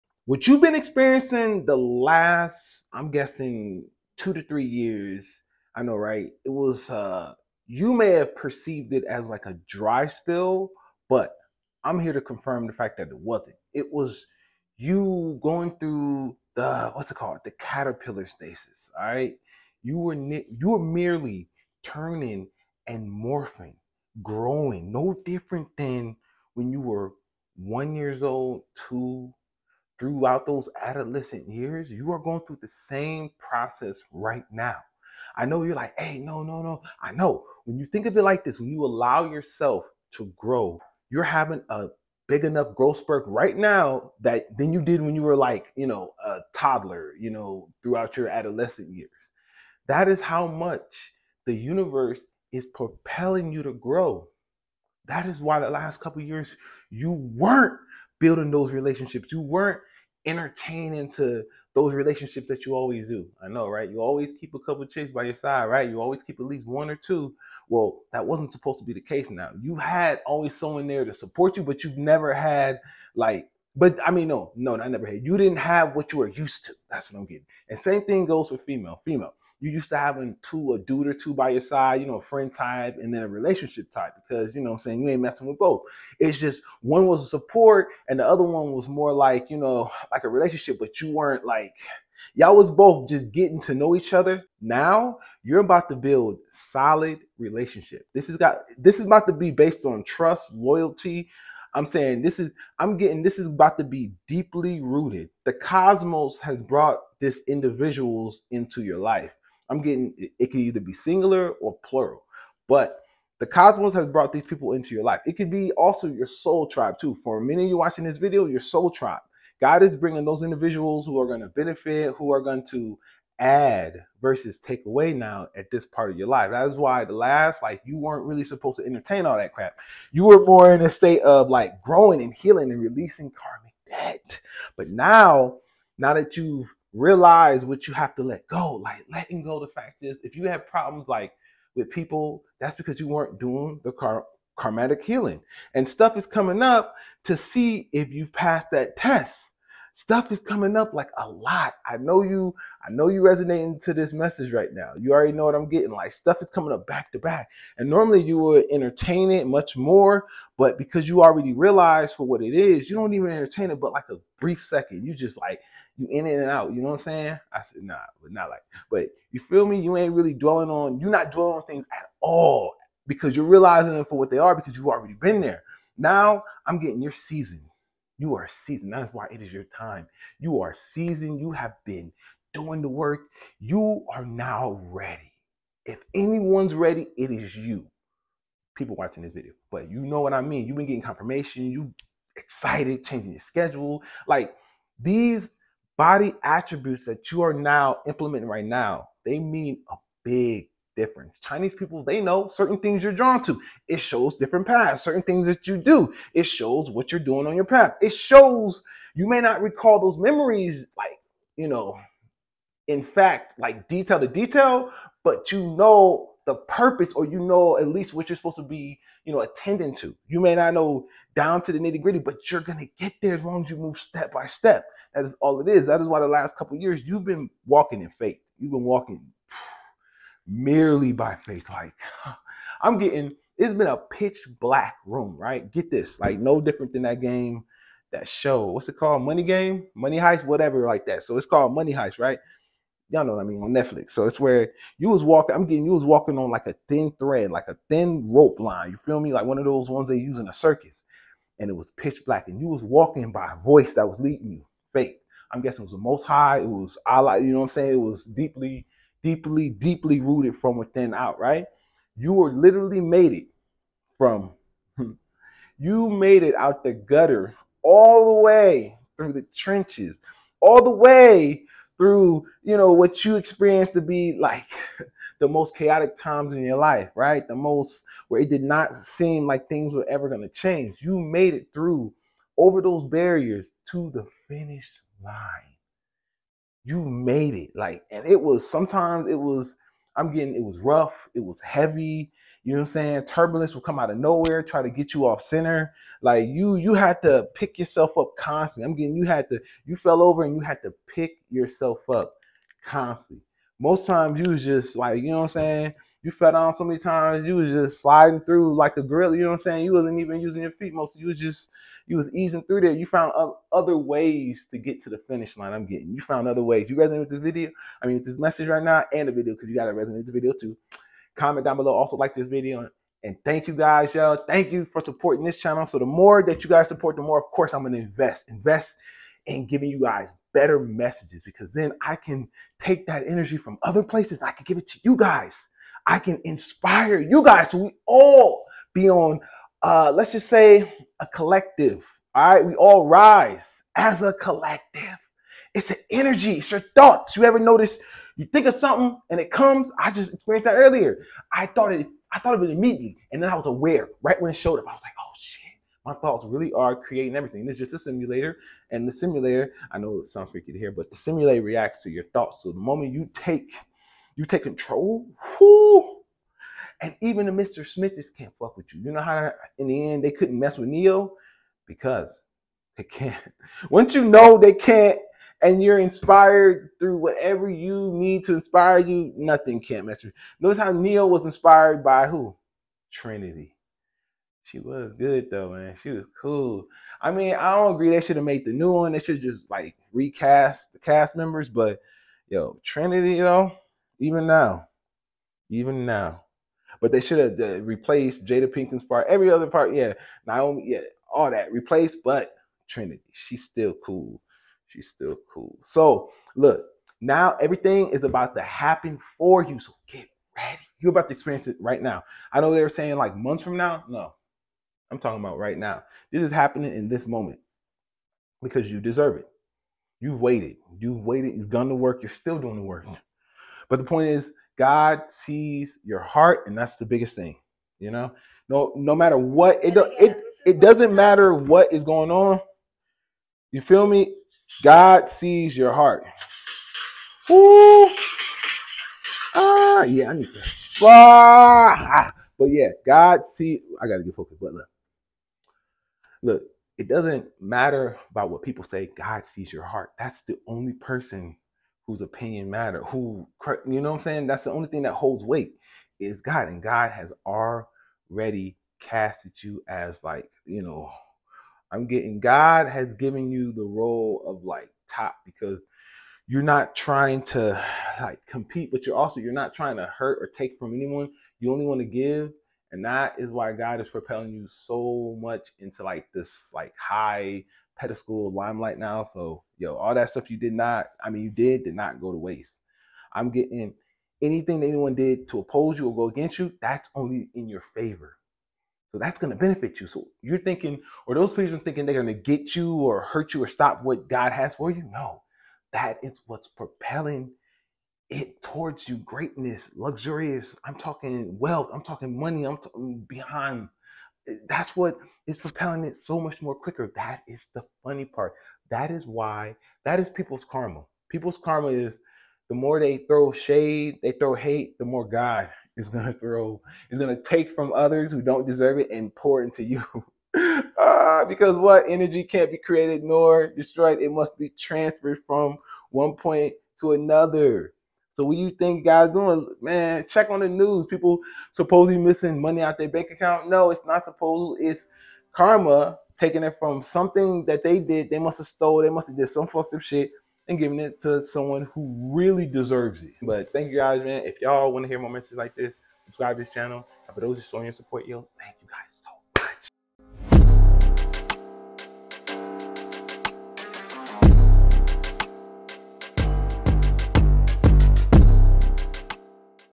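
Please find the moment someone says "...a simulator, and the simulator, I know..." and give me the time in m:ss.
5:57.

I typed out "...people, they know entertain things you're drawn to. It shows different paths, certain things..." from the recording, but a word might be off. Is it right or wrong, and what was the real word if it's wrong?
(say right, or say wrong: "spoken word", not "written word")
wrong: "certain", not "entertain".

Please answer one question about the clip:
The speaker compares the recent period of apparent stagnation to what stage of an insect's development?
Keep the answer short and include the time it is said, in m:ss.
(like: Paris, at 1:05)
caterpillar stasis, at 0:17.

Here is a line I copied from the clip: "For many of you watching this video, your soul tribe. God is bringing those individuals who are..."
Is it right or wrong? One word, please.
right.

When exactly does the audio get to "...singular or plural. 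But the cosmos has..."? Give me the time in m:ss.
1:50.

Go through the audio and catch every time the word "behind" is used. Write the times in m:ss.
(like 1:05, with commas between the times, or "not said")
8:23.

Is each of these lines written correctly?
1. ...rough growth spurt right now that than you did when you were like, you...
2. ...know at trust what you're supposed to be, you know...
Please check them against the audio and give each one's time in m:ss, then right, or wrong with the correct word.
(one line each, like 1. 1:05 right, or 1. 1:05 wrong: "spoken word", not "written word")
1. 0:42 wrong: "enough", not "rough"
2. 3:37 wrong: "least", not "trust".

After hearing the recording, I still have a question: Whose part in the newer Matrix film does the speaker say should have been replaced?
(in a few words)
Jada Pinkett.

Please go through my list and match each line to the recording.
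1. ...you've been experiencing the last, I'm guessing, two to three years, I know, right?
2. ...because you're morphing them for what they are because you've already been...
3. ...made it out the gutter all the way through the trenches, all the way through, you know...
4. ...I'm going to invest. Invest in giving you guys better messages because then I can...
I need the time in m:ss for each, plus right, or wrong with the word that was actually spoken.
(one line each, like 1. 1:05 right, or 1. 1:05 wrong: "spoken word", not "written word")
1. 0:00 right
2. 2:53 wrong: "realizing", not "morphing"
3. 4:26 right
4. 5:27 right.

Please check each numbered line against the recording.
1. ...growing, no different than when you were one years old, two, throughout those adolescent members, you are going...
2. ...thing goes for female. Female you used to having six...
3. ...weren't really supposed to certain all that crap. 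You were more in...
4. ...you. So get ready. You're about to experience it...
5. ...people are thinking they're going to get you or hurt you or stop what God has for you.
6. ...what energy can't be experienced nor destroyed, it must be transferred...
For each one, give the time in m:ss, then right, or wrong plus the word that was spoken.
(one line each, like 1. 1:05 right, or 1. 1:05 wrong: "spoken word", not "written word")
1. 0:24 wrong: "years", not "members"
2. 1:18 wrong: "two", not "six"
3. 2:07 wrong: "entertain", not "certain"
4. 6:49 right
5. 8:11 right
6. 8:41 wrong: "created", not "experienced".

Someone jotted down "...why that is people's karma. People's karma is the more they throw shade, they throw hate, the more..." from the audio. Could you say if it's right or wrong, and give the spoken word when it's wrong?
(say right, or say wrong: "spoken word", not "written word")
right.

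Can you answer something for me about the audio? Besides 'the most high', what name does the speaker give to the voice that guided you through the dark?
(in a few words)
Allah.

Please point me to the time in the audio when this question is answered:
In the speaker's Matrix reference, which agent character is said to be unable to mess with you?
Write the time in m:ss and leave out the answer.
6:07.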